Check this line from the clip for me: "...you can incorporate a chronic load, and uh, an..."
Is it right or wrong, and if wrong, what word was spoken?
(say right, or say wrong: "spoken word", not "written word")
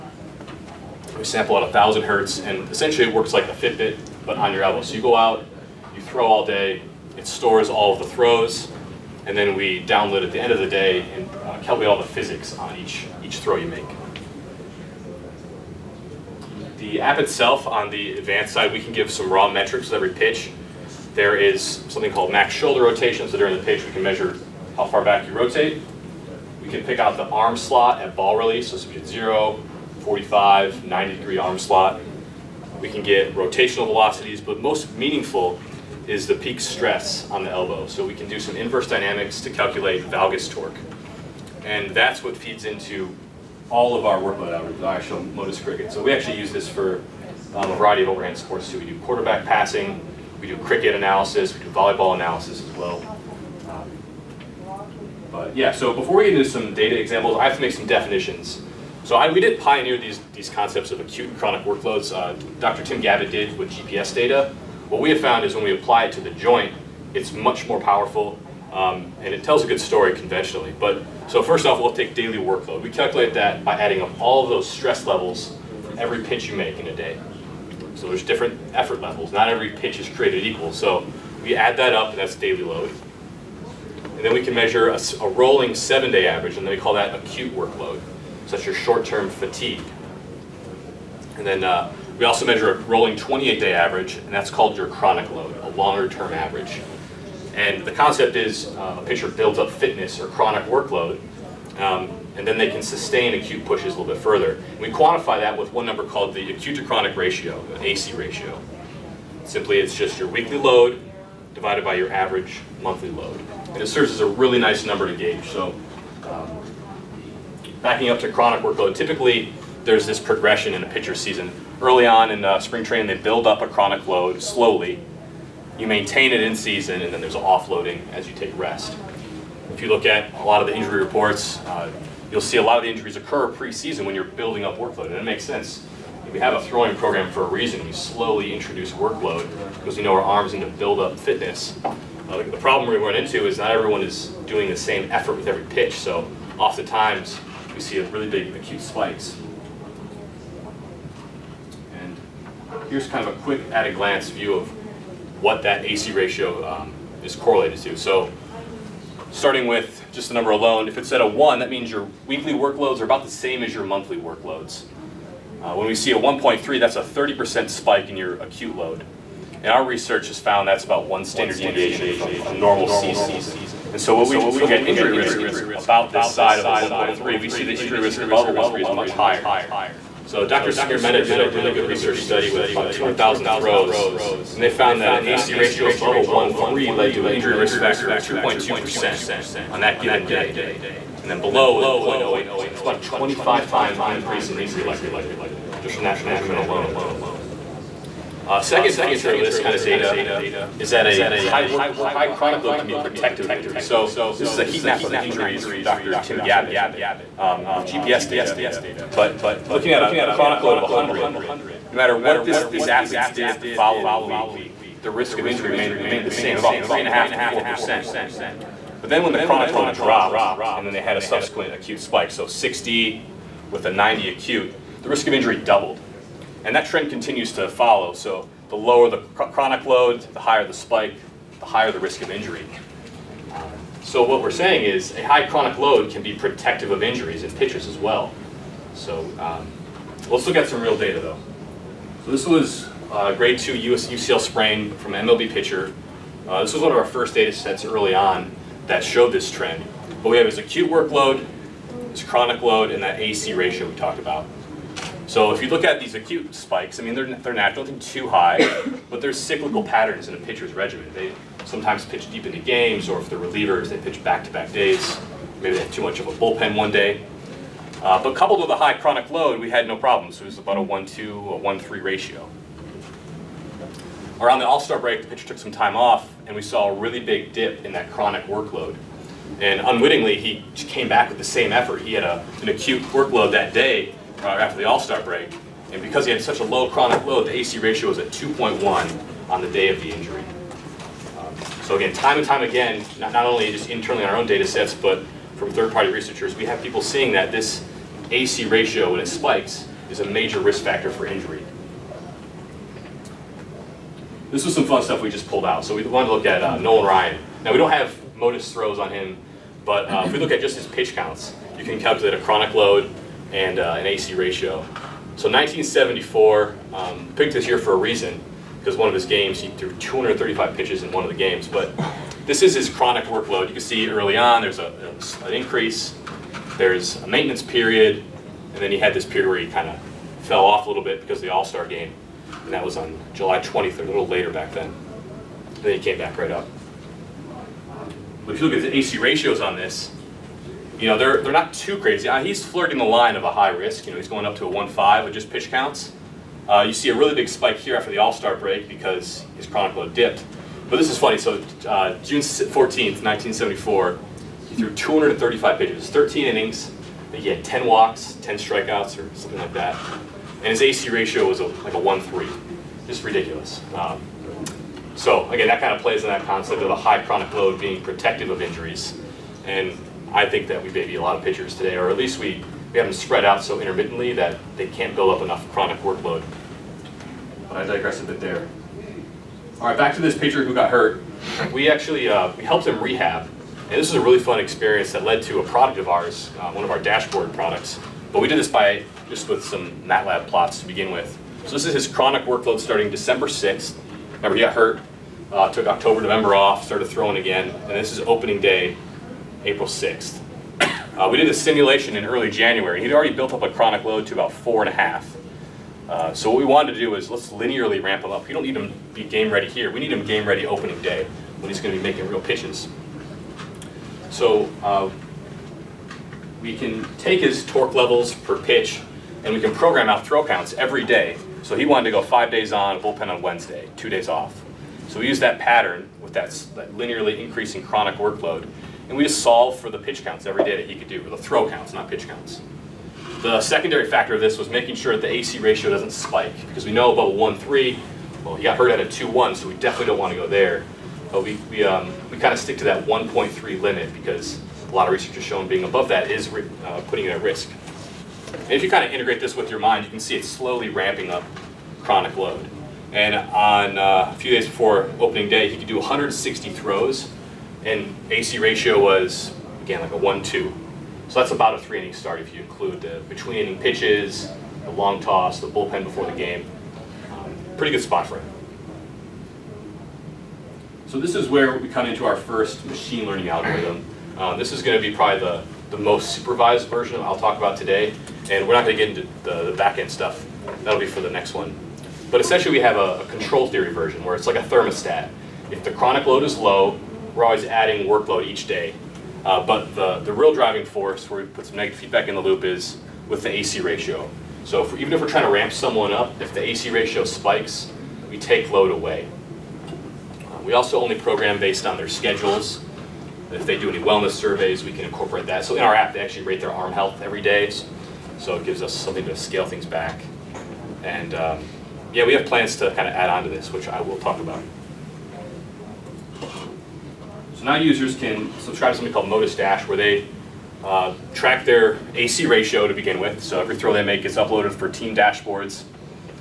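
wrong: "calculate", not "incorporate".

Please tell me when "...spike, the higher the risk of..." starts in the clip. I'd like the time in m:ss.
3:50.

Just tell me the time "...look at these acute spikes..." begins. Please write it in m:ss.
4:15.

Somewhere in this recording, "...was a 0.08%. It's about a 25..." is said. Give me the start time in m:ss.
3:11.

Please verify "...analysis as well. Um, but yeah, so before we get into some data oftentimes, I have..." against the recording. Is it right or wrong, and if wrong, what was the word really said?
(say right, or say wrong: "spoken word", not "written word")
wrong: "examples", not "oftentimes".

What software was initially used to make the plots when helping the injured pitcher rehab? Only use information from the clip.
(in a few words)
MATLAB.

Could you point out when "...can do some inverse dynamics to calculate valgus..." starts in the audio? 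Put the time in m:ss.
0:38.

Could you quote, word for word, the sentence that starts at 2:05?
You maintain it in season, and then there's offloading as you take rest.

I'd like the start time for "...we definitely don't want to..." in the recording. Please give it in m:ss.
7:19.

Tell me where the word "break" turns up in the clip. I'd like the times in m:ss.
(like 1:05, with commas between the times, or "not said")
4:34, 4:45, 5:48.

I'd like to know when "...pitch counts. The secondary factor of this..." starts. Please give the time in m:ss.
7:12.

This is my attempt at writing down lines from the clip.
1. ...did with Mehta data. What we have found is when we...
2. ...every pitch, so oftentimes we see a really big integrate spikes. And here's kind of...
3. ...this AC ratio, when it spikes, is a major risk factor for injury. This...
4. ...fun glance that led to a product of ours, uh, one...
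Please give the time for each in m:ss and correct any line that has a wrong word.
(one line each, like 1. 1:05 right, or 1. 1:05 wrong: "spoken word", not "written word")
1. 1:03 wrong: "GPS", not "Mehta"
2. 2:25 wrong: "acute", not "integrate"
3. 4:57 right
4. 6:24 wrong: "experience", not "glance".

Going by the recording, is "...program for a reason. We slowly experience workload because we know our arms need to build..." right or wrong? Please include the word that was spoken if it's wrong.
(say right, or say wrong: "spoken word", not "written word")
wrong: "introduce", not "experience".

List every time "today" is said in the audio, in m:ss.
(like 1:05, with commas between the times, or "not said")
6:11, 7:57.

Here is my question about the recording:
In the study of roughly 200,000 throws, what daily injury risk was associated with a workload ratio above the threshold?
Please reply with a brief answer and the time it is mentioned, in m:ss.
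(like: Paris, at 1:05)
2.2%, at 3:08.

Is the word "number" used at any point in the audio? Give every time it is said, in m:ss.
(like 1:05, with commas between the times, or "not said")
1:45, 1:54, 2:40.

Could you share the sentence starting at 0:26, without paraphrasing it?
We can pick out the arm slot at ball release, so it's zero, 45, 90 degree arm slot.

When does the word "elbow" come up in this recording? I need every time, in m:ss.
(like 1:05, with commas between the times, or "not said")
0:04, 0:37.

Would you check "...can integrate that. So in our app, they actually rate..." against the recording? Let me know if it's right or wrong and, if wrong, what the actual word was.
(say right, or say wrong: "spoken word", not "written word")
wrong: "incorporate", not "integrate".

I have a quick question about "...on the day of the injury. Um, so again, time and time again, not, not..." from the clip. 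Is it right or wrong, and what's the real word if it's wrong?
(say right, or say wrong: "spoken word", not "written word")
right.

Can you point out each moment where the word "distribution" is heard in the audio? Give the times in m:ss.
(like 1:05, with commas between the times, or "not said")
not said.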